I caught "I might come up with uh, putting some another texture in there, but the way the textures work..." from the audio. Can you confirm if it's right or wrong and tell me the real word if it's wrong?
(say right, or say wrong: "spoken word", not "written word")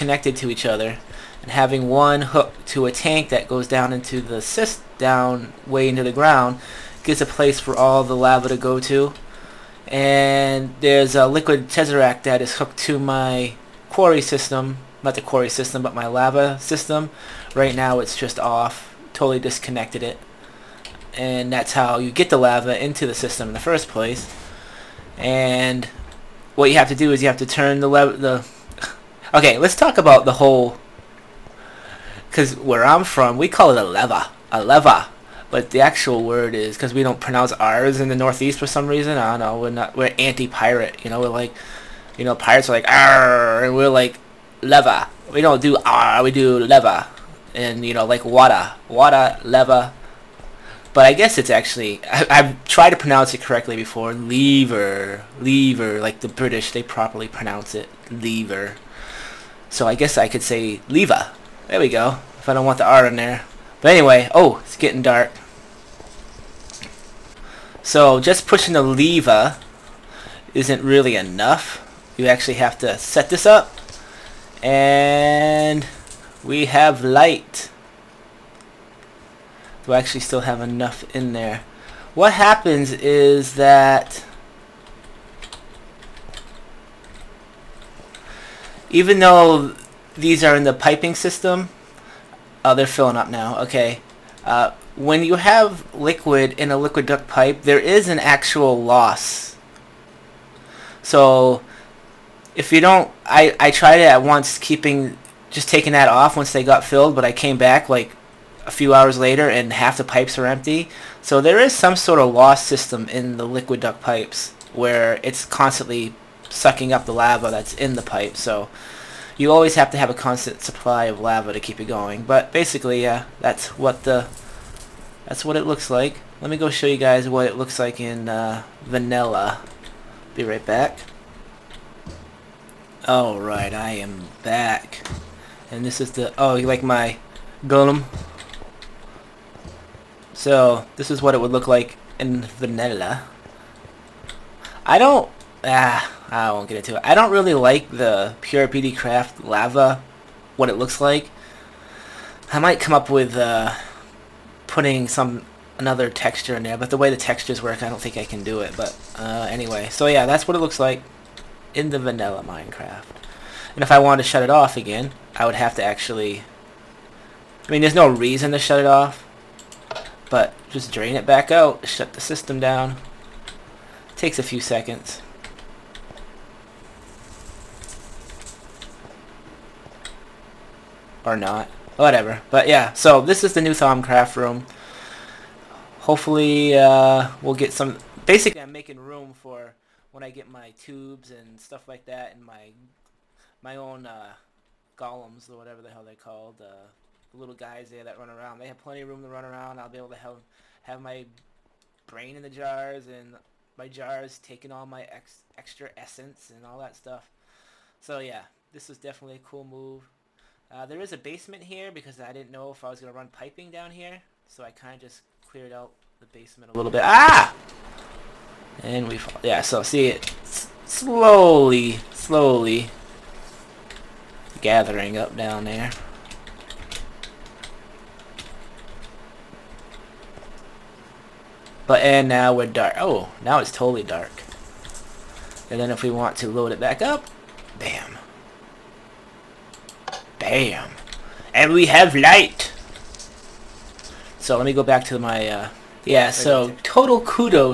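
right.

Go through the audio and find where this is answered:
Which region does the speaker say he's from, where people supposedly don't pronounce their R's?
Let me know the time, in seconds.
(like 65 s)
38 s.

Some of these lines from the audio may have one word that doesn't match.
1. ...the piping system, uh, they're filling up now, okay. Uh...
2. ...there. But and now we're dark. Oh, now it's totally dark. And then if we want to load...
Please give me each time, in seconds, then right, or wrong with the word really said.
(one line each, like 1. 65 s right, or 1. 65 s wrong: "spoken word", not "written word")
1. 90 s right
2. 225 s right.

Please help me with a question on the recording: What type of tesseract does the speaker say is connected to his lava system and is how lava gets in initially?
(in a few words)
liquid tesseract.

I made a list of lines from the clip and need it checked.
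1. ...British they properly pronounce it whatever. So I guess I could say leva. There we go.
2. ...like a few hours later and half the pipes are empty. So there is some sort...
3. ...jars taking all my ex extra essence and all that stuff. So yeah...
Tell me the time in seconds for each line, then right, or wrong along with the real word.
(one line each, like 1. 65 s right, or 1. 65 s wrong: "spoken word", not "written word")
1. 56 s wrong: "lever", not "whatever"
2. 107 s right
3. 203 s right.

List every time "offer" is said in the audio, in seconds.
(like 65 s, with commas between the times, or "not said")
not said.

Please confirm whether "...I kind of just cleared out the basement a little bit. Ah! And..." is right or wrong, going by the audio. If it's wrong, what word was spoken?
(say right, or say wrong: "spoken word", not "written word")
right.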